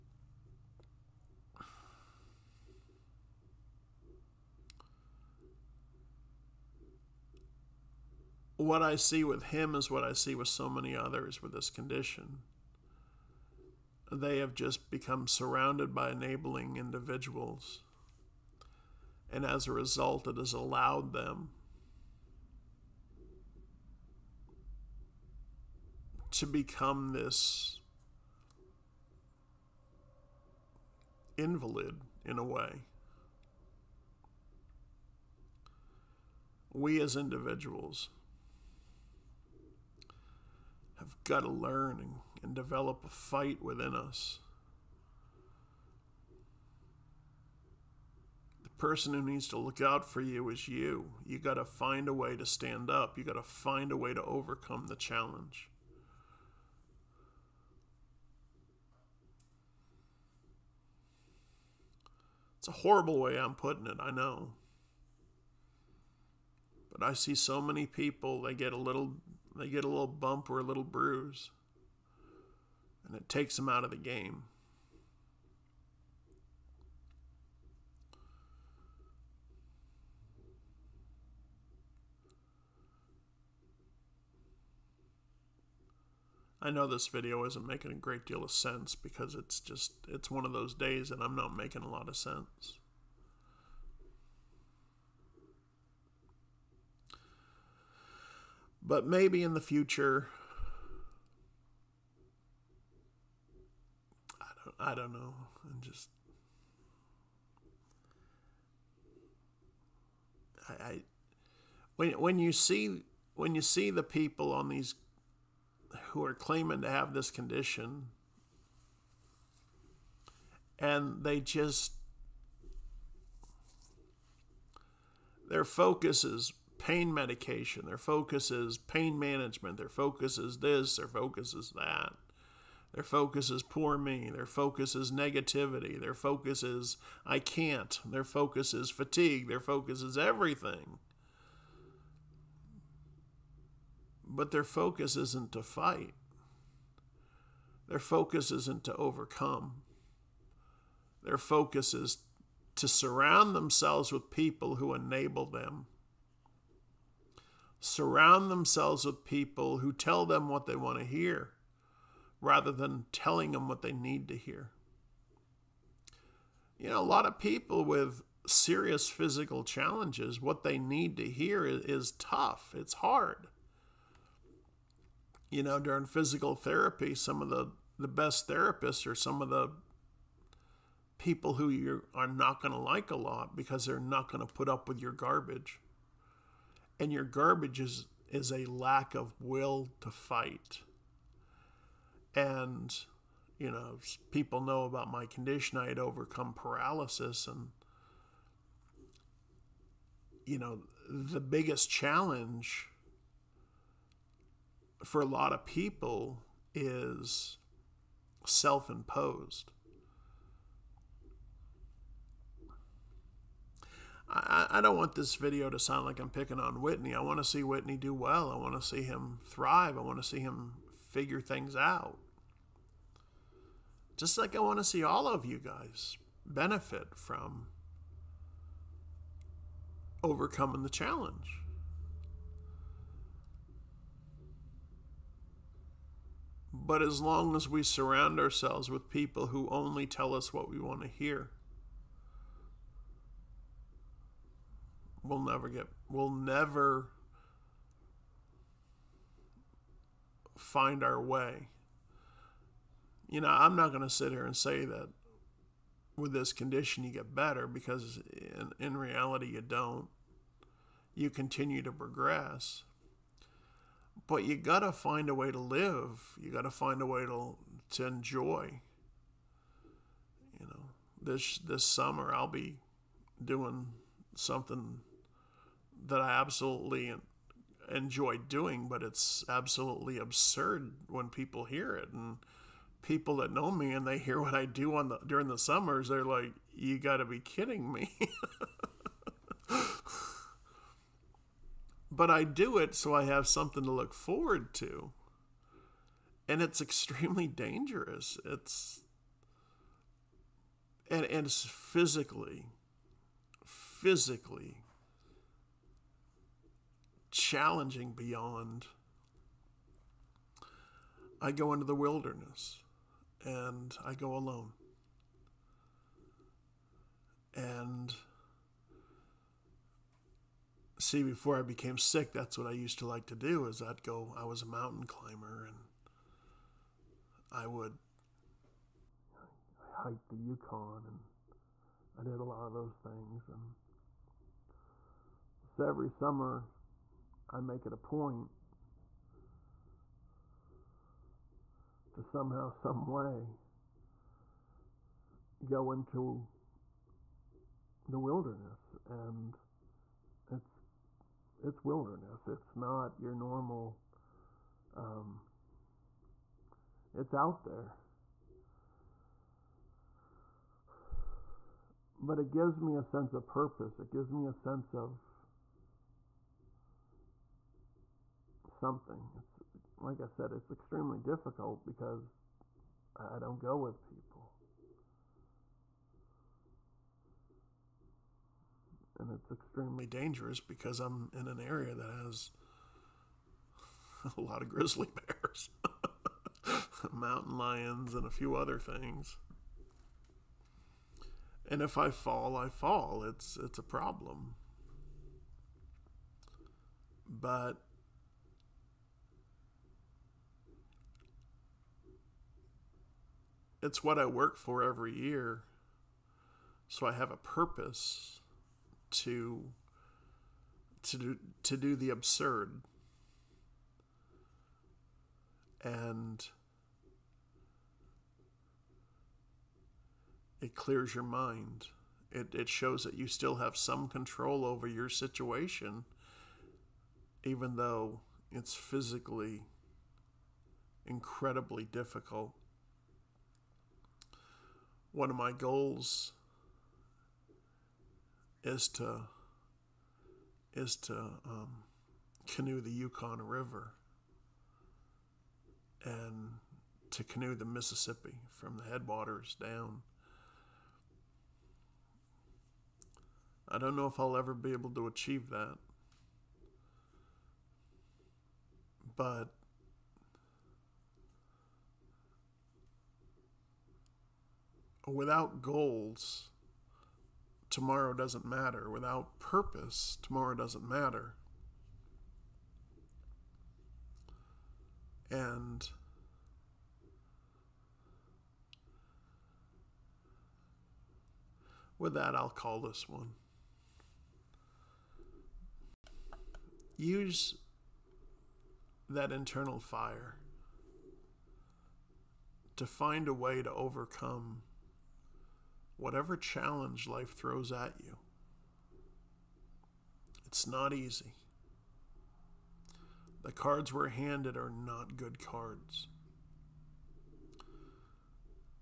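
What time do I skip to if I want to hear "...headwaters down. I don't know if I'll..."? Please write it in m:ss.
7:28.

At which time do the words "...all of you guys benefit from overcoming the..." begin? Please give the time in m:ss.
3:45.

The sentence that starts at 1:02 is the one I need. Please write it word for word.
It's a horrible way I'm putting it, I know.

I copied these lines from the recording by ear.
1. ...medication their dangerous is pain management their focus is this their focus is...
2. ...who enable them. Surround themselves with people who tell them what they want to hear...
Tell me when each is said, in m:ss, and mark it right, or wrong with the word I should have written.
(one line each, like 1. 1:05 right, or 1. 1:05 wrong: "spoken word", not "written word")
1. 2:07 wrong: "focus", not "dangerous"
2. 2:34 right.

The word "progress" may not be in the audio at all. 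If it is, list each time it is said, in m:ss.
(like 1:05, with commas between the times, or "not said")
4:21.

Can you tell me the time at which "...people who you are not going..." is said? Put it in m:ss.
3:01.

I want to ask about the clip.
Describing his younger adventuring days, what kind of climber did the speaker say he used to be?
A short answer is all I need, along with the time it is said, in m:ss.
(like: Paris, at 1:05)
Mountain climber, at 5:24.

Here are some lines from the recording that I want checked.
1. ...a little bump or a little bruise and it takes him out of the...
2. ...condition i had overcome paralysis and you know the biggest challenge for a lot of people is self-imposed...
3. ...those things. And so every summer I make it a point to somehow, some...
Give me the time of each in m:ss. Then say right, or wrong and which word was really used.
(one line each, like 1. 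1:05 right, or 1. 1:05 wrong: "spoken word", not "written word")
1. 1:09 right
2. 3:15 right
3. 5:32 right.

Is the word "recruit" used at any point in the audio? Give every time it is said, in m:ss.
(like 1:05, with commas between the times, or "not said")
not said.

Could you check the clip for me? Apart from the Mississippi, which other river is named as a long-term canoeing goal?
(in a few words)
Yukon River.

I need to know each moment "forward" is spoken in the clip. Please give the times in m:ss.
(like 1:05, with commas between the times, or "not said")
4:54.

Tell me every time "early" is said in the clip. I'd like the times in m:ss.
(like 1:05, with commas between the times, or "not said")
not said.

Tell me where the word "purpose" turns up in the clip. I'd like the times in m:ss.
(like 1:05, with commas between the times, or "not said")
6:03, 6:47, 7:49.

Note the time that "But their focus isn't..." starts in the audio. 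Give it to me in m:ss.
2:24.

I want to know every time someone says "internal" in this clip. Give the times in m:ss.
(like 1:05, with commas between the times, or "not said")
8:09.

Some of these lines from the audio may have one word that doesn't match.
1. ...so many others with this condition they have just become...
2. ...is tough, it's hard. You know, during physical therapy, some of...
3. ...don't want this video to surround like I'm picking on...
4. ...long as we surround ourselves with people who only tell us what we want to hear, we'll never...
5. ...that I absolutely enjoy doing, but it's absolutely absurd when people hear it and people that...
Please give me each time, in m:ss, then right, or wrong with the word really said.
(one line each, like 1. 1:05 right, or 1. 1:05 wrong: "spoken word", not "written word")
1. 0:10 right
2. 2:51 right
3. 3:34 wrong: "sound", not "surround"
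4. 3:57 right
5. 4:36 right.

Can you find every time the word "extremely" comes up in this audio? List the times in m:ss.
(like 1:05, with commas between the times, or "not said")
4:56, 6:10, 6:19.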